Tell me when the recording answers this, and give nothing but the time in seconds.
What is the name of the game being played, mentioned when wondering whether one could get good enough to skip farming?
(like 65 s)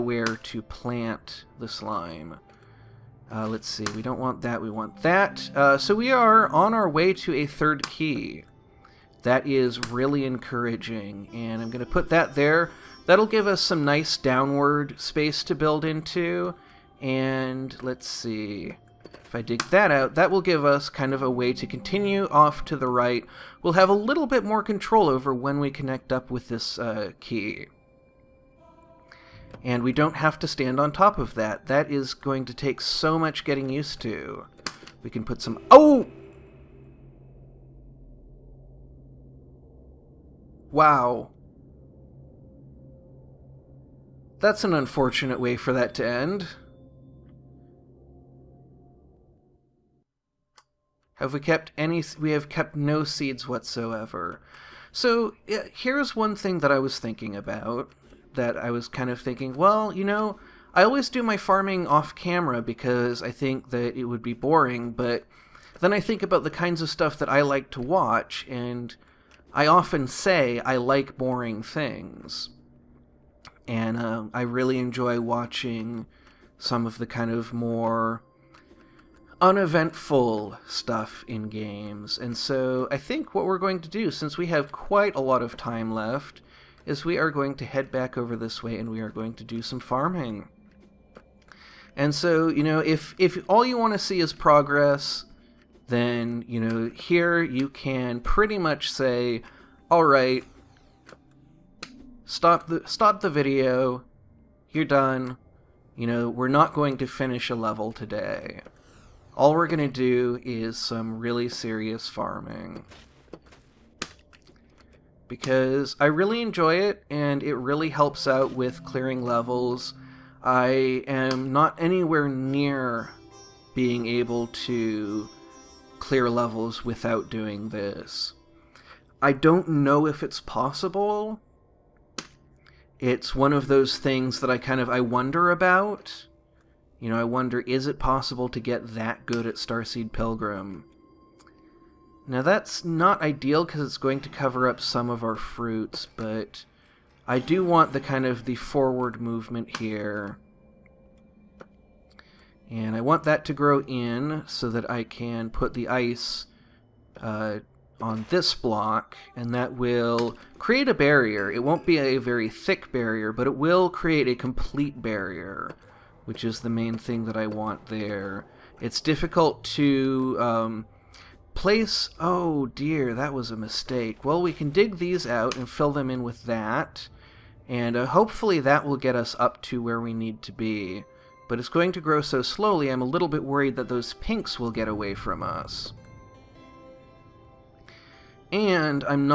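139 s.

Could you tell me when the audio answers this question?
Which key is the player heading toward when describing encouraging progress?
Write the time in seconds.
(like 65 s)
7 s.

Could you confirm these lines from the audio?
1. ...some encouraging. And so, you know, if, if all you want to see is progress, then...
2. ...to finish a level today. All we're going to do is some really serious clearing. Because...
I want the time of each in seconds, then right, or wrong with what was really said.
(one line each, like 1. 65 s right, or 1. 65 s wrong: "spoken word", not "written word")
1. 89 s wrong: "farming", not "encouraging"
2. 106 s wrong: "farming", not "clearing".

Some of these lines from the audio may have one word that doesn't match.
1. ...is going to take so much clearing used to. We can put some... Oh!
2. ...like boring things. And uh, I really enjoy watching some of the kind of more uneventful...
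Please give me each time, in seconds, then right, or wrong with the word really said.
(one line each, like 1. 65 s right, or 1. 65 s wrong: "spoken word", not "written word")
1. 31 s wrong: "getting", not "clearing"
2. 70 s right.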